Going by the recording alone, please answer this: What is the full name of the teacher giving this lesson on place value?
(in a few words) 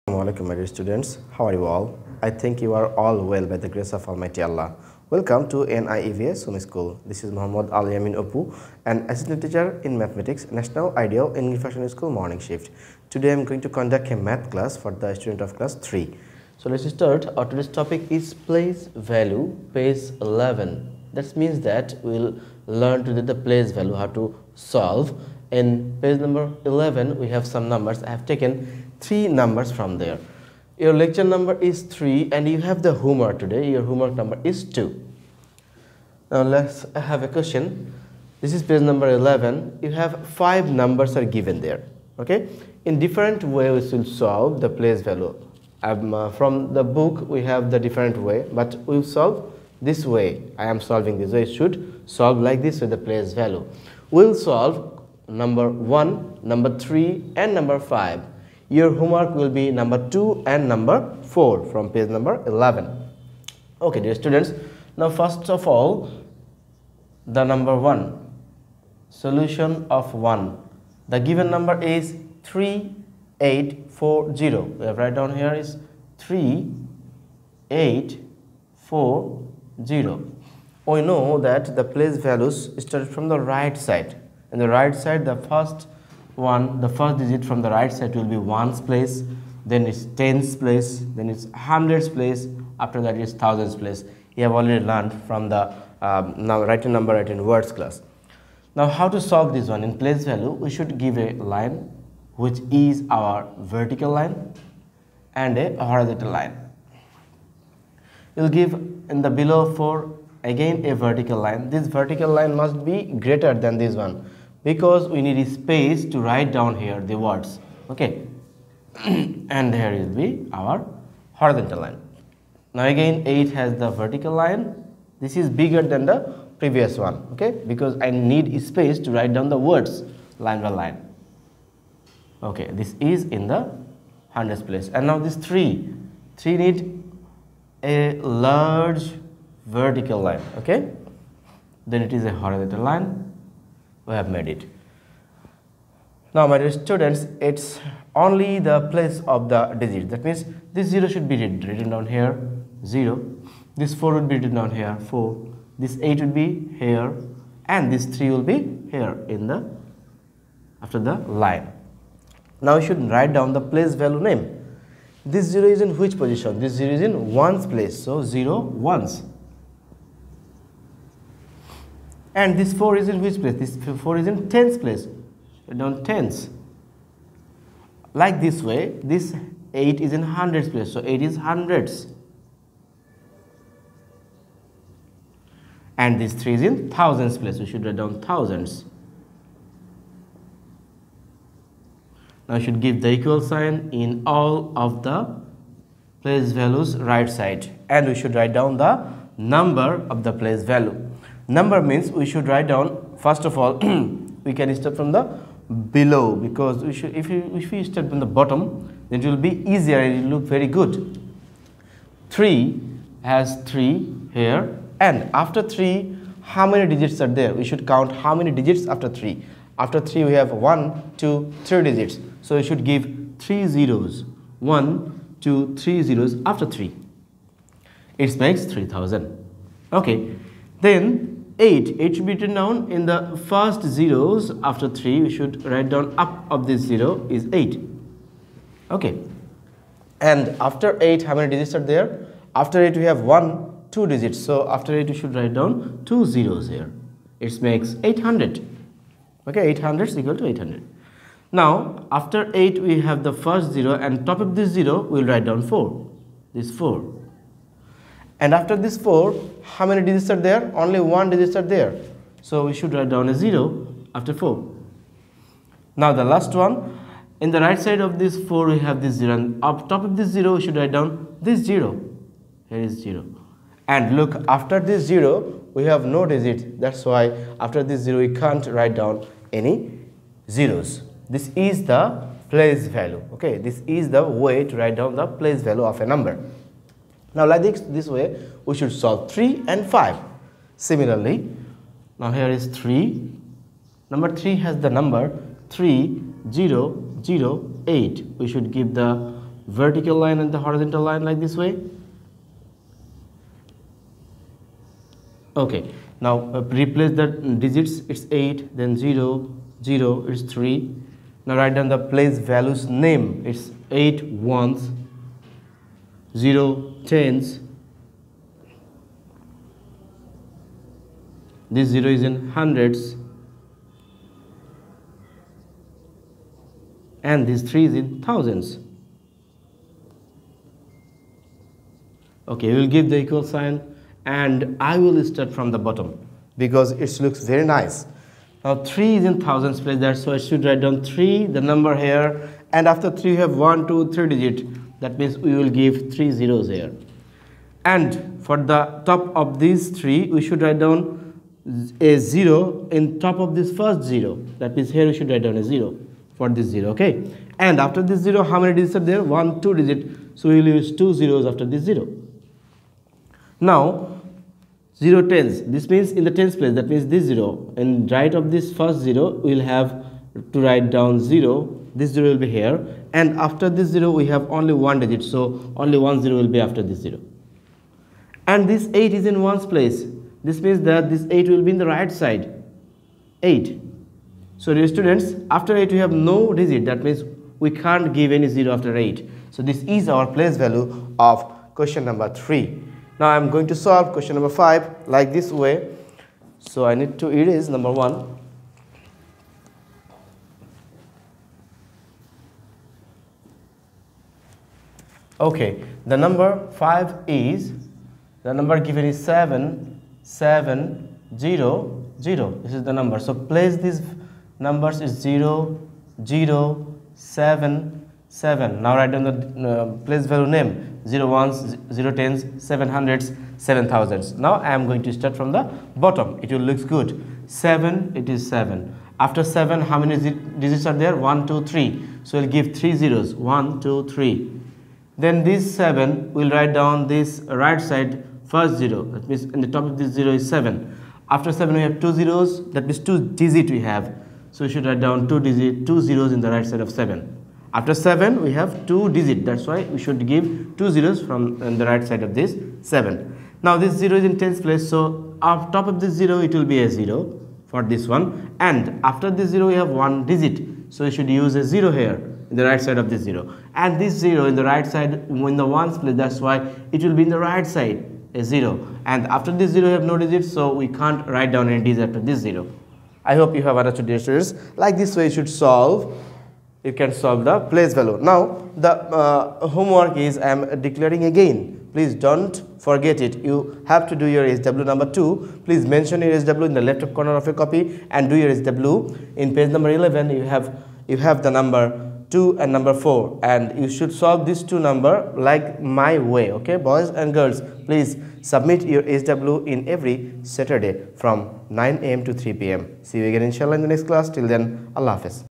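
Muhammad Al Yamin Apu.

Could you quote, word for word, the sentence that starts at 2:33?
This 4 would be written down here, 4.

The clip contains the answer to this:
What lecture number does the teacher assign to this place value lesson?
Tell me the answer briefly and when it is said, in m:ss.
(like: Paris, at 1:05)
3, at 0:30.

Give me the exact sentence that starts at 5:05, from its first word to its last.
Okay, now uh, replace the digits, it's 8, then 0, 0, it's 3.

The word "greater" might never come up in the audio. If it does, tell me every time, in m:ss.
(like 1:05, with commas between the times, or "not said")
1:53.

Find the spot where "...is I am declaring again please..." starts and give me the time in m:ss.
8:00.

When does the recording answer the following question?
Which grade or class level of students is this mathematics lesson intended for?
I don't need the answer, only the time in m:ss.
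0:15.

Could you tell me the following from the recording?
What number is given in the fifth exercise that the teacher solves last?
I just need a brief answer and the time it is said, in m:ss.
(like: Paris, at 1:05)
7700, at 6:49.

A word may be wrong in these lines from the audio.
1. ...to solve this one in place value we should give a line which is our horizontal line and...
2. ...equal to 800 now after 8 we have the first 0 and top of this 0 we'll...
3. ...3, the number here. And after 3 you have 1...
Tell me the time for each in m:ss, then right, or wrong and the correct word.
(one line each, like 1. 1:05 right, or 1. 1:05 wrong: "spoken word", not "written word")
1. 1:39 wrong: "vertical", not "horizontal"
2. 4:10 right
3. 5:41 right.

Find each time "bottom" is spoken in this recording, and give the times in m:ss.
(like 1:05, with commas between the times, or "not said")
3:28, 5:35, 7:05.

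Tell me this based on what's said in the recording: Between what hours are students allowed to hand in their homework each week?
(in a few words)
9 a.m. to 3 p.m.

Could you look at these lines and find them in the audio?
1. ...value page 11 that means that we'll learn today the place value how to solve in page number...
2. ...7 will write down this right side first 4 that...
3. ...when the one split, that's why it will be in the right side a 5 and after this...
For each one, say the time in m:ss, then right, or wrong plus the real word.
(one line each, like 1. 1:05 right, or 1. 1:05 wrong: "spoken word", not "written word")
1. 0:19 right
2. 7:15 wrong: "0", not "4"
3. 7:45 wrong: "0", not "5".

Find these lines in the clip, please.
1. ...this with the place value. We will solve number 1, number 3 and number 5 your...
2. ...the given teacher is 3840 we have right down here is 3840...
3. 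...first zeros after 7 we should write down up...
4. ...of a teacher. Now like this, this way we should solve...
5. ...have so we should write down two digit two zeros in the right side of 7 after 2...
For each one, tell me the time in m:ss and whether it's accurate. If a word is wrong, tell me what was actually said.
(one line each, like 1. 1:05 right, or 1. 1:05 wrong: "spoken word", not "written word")
1. 0:52 right
2. 1:11 wrong: "number", not "teacher"
3. 3:53 wrong: "3", not "7"
4. 4:45 wrong: "number", not "teacher"
5. 7:23 wrong: "7", not "2".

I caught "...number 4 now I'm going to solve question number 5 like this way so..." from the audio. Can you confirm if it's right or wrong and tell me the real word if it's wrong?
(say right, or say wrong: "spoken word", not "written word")
wrong: "3", not "4".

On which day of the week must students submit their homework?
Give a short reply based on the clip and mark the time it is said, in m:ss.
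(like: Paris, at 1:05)
Saturday, at 8:19.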